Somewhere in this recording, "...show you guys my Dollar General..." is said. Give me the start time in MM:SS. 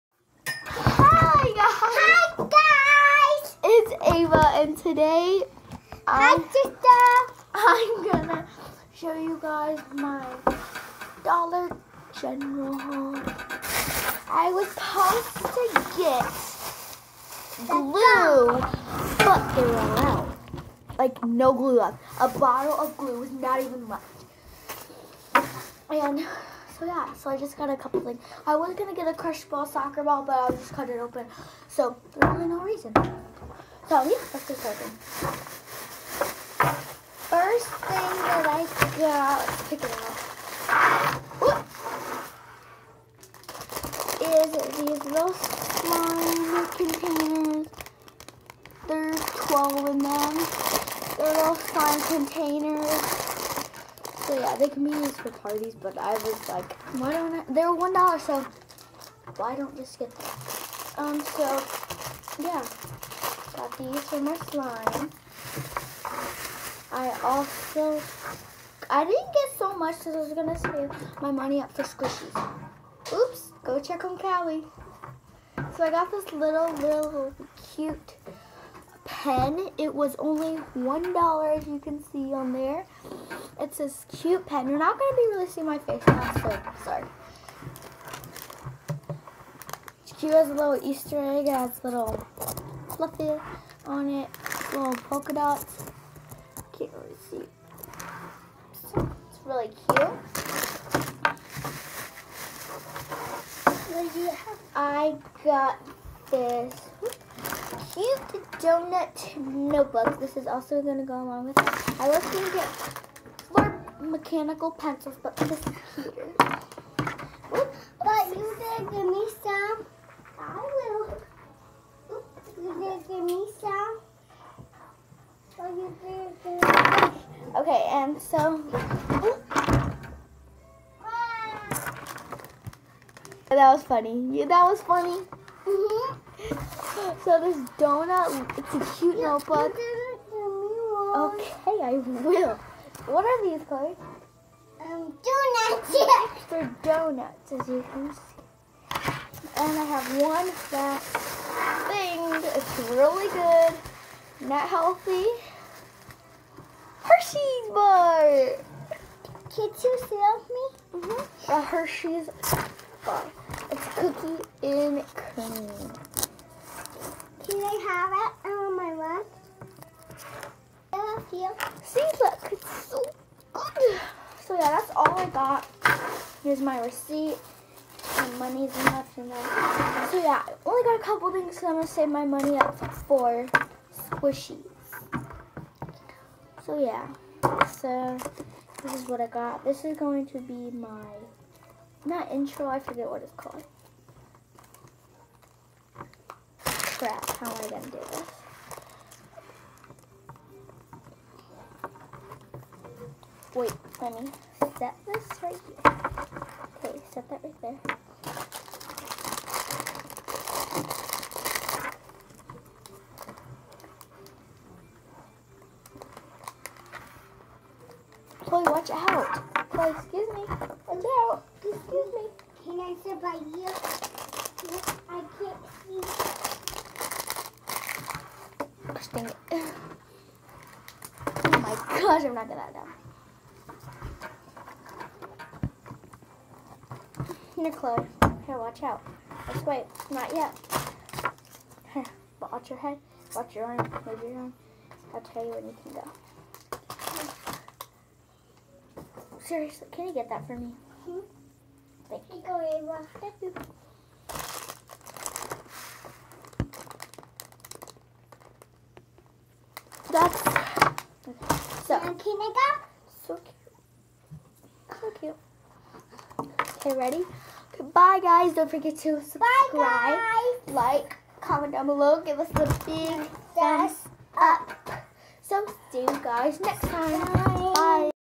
00:08.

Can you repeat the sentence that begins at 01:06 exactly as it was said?
I also, I didn't get so much because I was going to save my money up for squishies.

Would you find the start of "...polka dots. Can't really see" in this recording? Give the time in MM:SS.
01:35.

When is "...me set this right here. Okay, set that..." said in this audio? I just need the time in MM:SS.
03:24.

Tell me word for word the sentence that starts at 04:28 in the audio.
Don't forget to subscribe, like, comment down below.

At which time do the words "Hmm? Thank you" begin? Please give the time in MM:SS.
04:11.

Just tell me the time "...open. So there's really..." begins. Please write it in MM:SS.
00:30.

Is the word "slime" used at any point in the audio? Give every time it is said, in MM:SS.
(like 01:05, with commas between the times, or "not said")
00:45, 00:51, 01:04.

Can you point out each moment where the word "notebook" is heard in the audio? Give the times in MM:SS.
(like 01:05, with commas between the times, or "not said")
01:49, 02:19.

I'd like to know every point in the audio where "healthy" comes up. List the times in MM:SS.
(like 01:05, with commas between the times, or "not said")
02:34.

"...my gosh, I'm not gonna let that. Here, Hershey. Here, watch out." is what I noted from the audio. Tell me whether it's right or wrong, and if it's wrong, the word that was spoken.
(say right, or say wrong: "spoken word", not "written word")
wrong: "Chloe", not "Hershey".